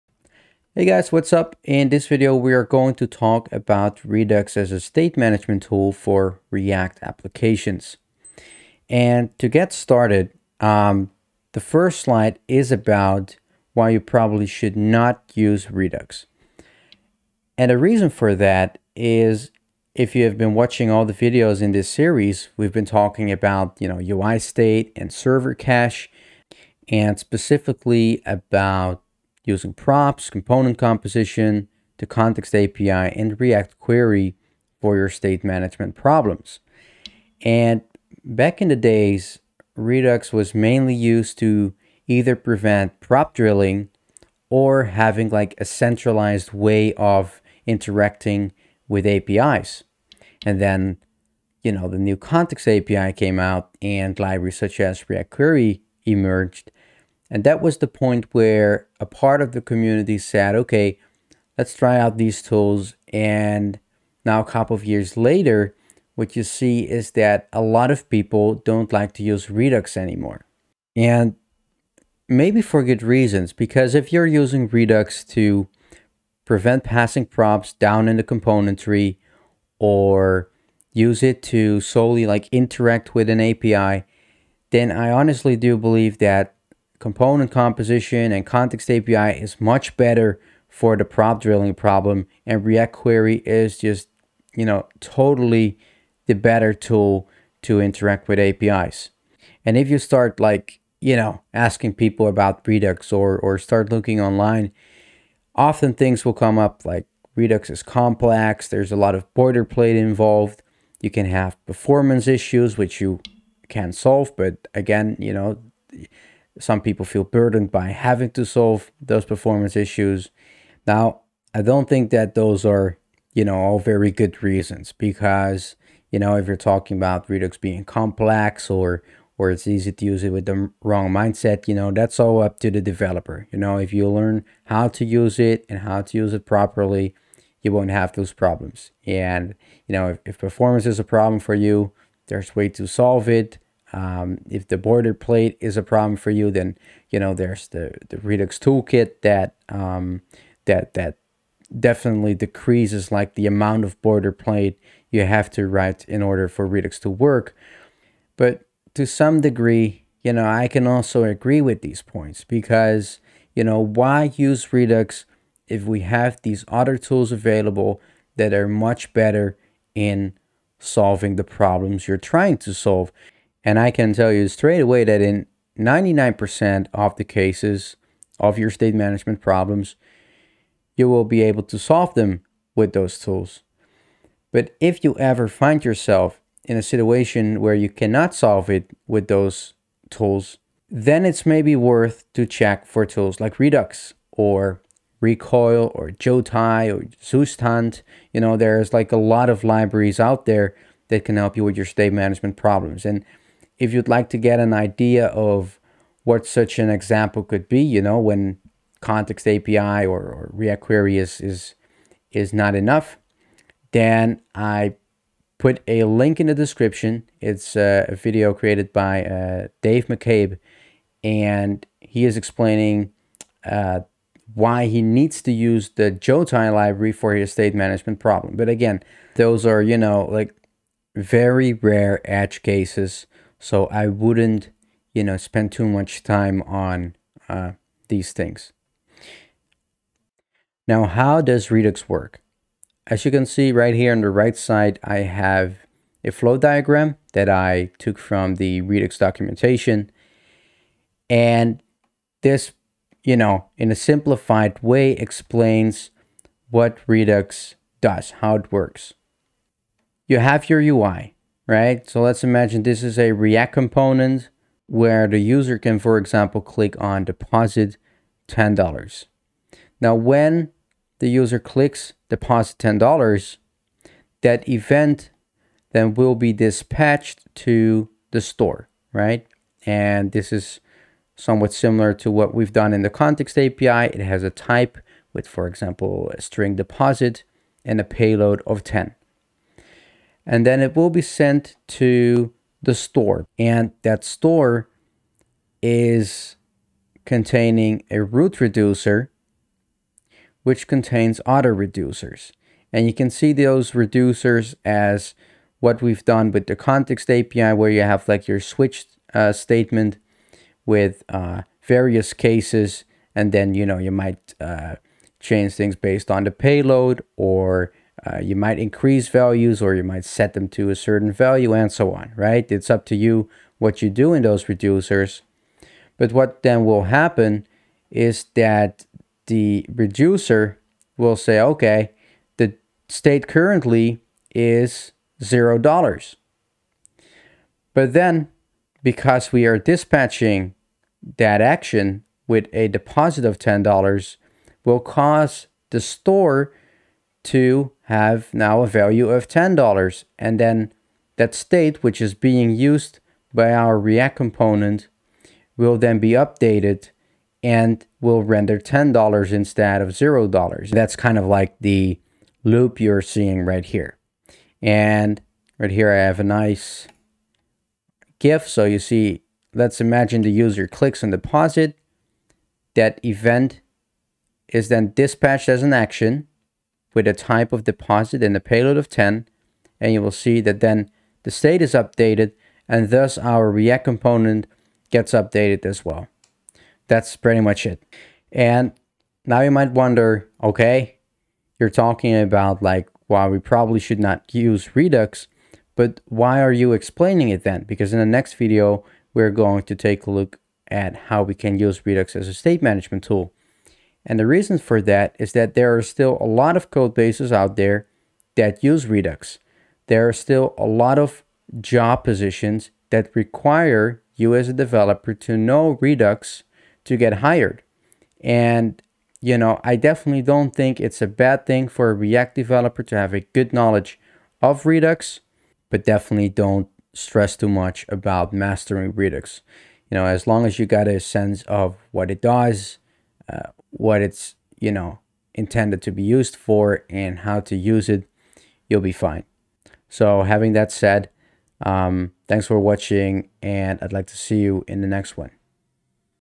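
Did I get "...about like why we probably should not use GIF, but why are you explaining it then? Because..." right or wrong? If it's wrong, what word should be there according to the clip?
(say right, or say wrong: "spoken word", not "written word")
wrong: "Redux", not "GIF".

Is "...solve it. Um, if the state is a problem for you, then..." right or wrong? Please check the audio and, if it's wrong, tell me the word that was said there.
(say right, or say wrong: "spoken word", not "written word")
wrong: "boilerplate", not "state".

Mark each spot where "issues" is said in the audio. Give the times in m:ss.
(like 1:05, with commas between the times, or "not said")
1:52, 1:59.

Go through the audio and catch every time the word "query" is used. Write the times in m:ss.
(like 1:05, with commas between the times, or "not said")
0:33, 0:55, 1:32, 3:30.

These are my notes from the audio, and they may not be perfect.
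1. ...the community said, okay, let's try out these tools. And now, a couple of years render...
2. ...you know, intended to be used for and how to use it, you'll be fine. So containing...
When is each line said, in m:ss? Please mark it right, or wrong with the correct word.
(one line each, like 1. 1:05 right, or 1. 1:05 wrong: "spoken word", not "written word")
1. 0:59 wrong: "later", not "render"
2. 7:14 wrong: "having", not "containing".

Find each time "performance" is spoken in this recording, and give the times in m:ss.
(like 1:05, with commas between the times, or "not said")
1:51, 1:59, 2:20.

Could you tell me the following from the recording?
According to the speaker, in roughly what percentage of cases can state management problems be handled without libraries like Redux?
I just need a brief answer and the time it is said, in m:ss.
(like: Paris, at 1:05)
99%, at 2:55.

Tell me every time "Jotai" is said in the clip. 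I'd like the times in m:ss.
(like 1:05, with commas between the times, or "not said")
3:16, 3:46.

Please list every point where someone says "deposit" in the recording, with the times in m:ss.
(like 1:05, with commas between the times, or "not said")
4:27, 4:32, 4:46, 5:42, 6:11, 6:17.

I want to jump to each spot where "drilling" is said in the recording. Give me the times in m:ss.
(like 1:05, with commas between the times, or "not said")
0:43, 1:31.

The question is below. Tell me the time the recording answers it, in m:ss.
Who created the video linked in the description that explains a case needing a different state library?
3:39.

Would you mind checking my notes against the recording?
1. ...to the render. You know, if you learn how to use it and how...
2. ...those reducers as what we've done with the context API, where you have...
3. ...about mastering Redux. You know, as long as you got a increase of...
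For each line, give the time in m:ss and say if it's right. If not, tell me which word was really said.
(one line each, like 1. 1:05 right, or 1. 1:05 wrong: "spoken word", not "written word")
1. 2:12 wrong: "developer", not "render"
2. 5:03 right
3. 7:08 wrong: "sense", not "increase".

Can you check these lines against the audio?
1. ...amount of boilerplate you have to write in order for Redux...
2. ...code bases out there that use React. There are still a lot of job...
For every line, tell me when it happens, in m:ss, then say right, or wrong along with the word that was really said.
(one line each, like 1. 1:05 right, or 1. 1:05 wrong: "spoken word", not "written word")
1. 2:33 right
2. 6:46 wrong: "Redux", not "React".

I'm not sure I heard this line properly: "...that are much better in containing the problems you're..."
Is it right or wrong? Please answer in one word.
wrong.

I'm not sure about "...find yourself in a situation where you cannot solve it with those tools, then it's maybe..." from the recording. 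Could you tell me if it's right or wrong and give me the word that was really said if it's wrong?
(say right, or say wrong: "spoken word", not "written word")
right.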